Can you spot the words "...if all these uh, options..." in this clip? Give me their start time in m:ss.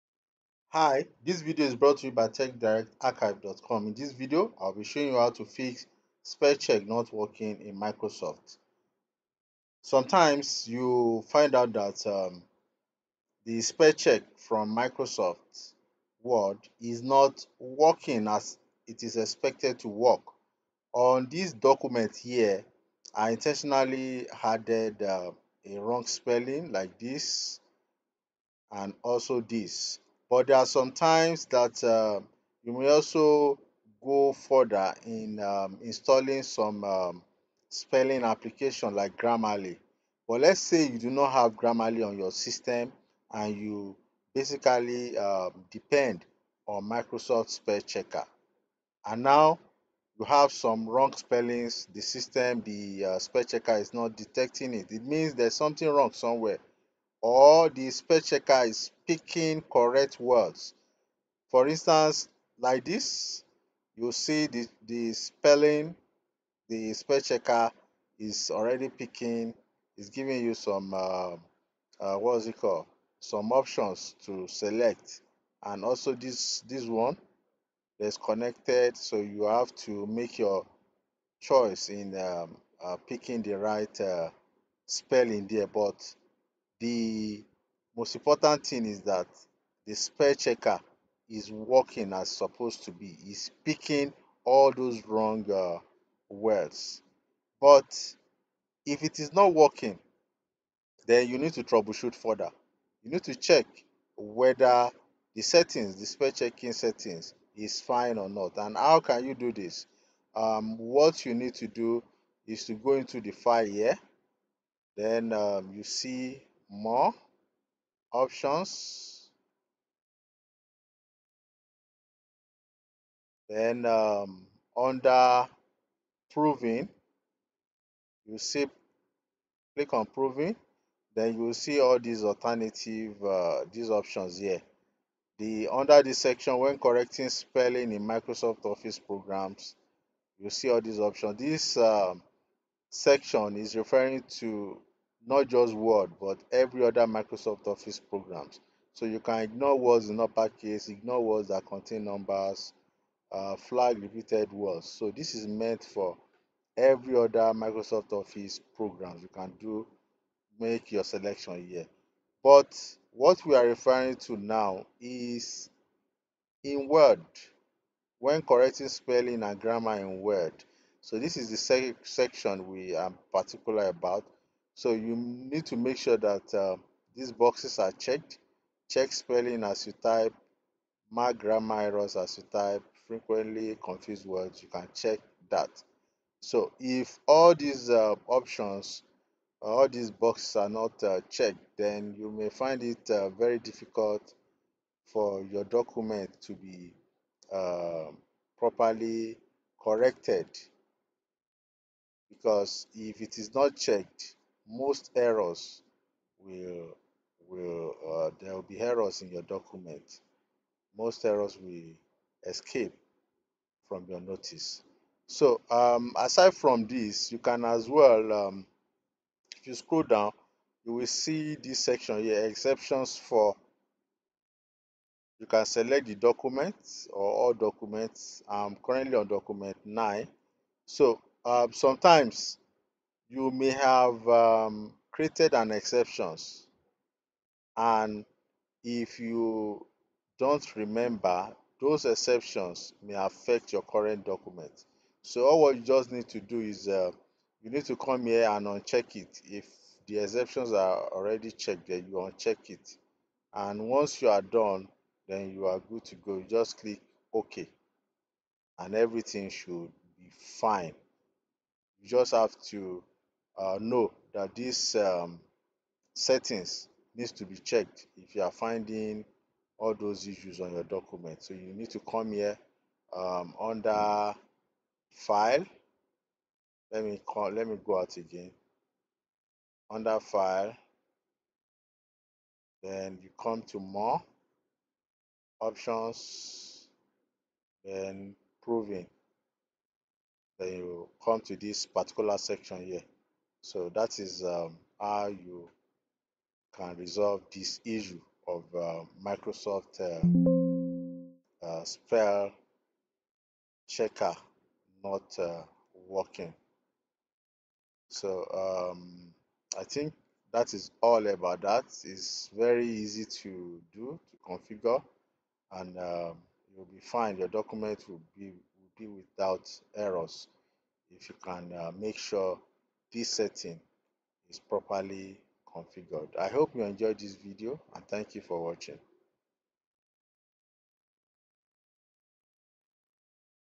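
3:06.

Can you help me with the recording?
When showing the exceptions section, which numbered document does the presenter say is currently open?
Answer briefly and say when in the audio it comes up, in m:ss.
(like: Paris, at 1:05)
Document 9, at 3:49.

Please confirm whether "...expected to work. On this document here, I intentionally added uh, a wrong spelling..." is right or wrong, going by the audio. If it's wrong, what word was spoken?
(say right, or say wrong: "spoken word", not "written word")
right.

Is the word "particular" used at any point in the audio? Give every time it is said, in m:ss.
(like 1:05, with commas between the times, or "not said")
2:53, 4:51.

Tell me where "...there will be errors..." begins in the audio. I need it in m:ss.
3:28.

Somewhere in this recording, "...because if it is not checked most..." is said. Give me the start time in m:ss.
3:22.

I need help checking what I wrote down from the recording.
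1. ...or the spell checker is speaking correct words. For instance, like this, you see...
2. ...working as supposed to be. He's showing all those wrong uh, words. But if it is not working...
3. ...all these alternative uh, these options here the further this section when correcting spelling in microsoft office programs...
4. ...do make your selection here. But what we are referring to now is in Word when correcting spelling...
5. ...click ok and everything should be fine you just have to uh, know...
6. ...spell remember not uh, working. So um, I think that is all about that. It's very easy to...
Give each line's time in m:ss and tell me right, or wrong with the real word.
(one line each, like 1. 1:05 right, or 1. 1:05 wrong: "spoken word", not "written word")
1. 0:57 right
2. 1:31 wrong: "picking", not "showing"
3. 2:11 wrong: "under", not "further"
4. 2:39 right
5. 4:16 right
6. 5:01 wrong: "checker", not "remember".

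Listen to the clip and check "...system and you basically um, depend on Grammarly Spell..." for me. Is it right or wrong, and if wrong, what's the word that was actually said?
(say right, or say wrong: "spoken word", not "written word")
wrong: "Microsoft", not "Grammarly".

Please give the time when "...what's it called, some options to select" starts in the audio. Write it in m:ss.
1:12.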